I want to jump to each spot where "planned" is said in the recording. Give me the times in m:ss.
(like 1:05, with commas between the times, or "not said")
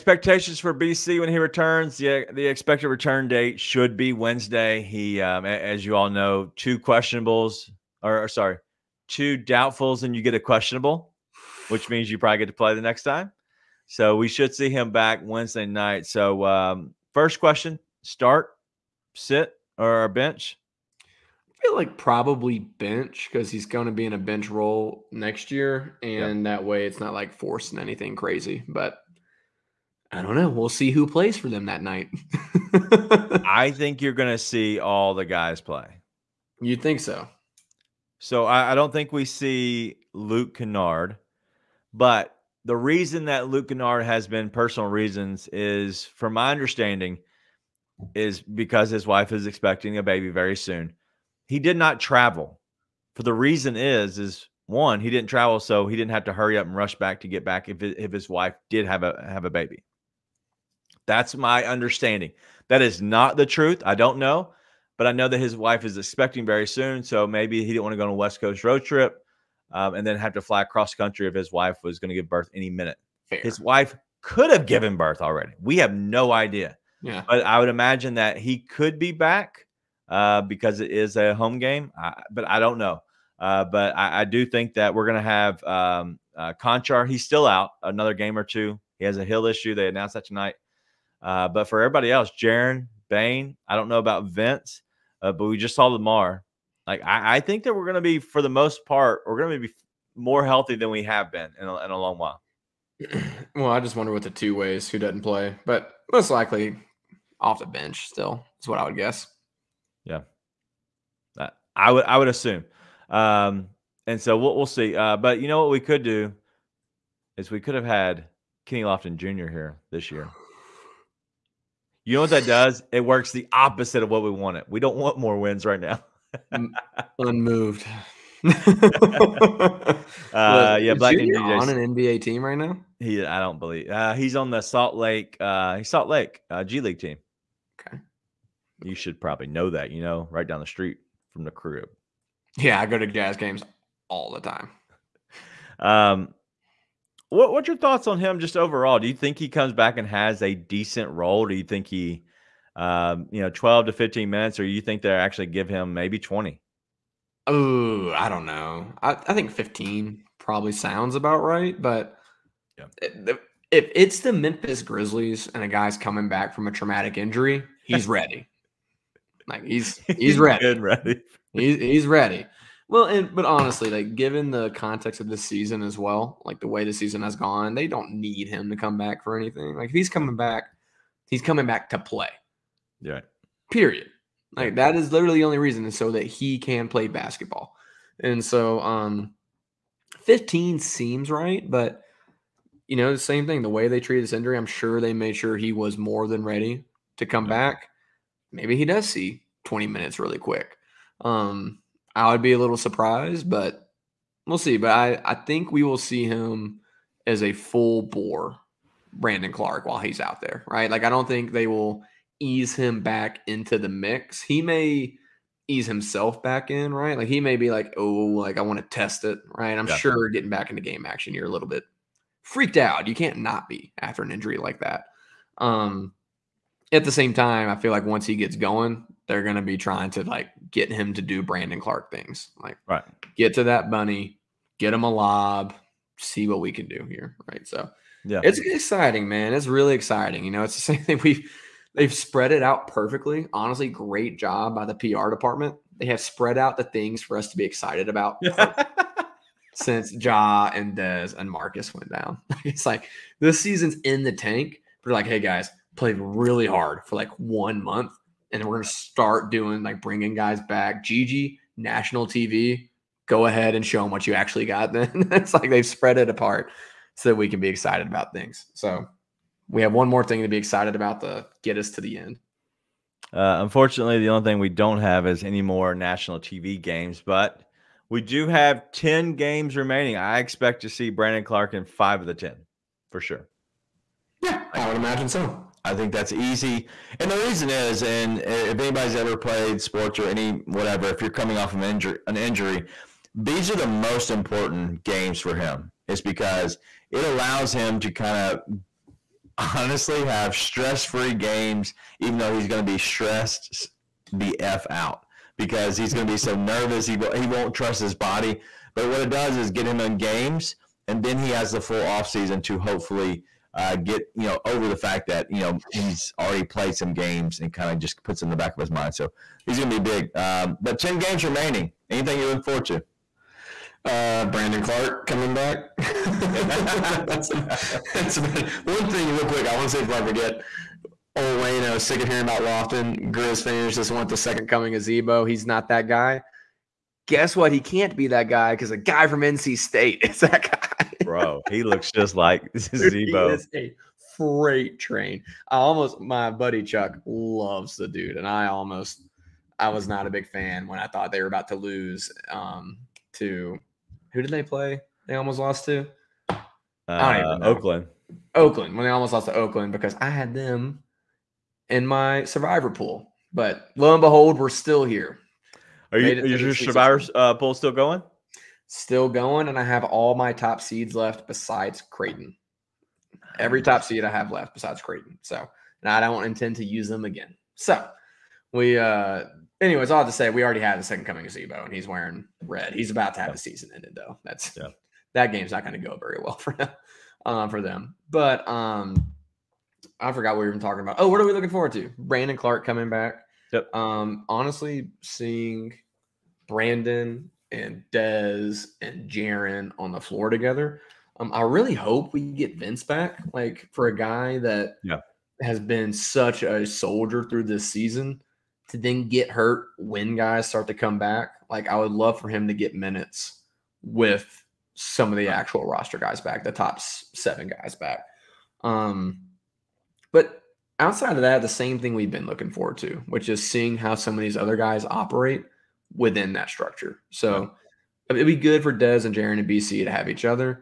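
not said.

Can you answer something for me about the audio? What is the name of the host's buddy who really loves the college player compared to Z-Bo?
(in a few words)
Chuck.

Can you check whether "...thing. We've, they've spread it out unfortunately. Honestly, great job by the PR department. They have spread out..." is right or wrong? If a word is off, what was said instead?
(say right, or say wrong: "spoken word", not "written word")
wrong: "perfectly", not "unfortunately".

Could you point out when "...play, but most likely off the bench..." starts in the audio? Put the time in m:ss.
1:45.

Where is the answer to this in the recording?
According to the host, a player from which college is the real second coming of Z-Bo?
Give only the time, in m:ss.
5:39.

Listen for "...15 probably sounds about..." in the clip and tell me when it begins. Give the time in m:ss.
2:39.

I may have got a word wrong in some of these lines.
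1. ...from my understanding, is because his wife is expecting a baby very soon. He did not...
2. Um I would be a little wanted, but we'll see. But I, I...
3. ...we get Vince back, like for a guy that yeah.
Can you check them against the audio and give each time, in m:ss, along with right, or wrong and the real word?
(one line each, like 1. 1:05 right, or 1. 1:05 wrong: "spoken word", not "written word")
1. 0:46 right
2. 3:21 wrong: "surprised", not "wanted"
3. 6:42 right.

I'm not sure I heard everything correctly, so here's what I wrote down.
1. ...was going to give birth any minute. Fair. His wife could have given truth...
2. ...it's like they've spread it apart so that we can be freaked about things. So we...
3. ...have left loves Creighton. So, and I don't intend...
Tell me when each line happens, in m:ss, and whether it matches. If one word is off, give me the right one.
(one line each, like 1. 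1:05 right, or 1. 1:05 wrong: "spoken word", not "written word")
1. 1:11 wrong: "birth", not "truth"
2. 4:25 wrong: "excited", not "freaked"
3. 6:14 wrong: "besides", not "loves".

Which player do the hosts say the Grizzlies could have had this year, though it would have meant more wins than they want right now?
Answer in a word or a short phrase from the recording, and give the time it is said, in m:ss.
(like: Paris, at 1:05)
Kenny Lofton Jr., at 1:58.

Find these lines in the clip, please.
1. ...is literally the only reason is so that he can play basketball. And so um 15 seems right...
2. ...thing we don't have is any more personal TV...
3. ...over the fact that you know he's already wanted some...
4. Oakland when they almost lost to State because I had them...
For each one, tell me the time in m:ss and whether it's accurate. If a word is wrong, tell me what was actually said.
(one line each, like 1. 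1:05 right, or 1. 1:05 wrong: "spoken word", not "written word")
1. 3:04 right
2. 4:34 wrong: "national", not "personal"
3. 5:14 wrong: "played", not "wanted"
4. 5:58 wrong: "Oakland", not "State".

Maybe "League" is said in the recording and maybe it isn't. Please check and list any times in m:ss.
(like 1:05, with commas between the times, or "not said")
2:16.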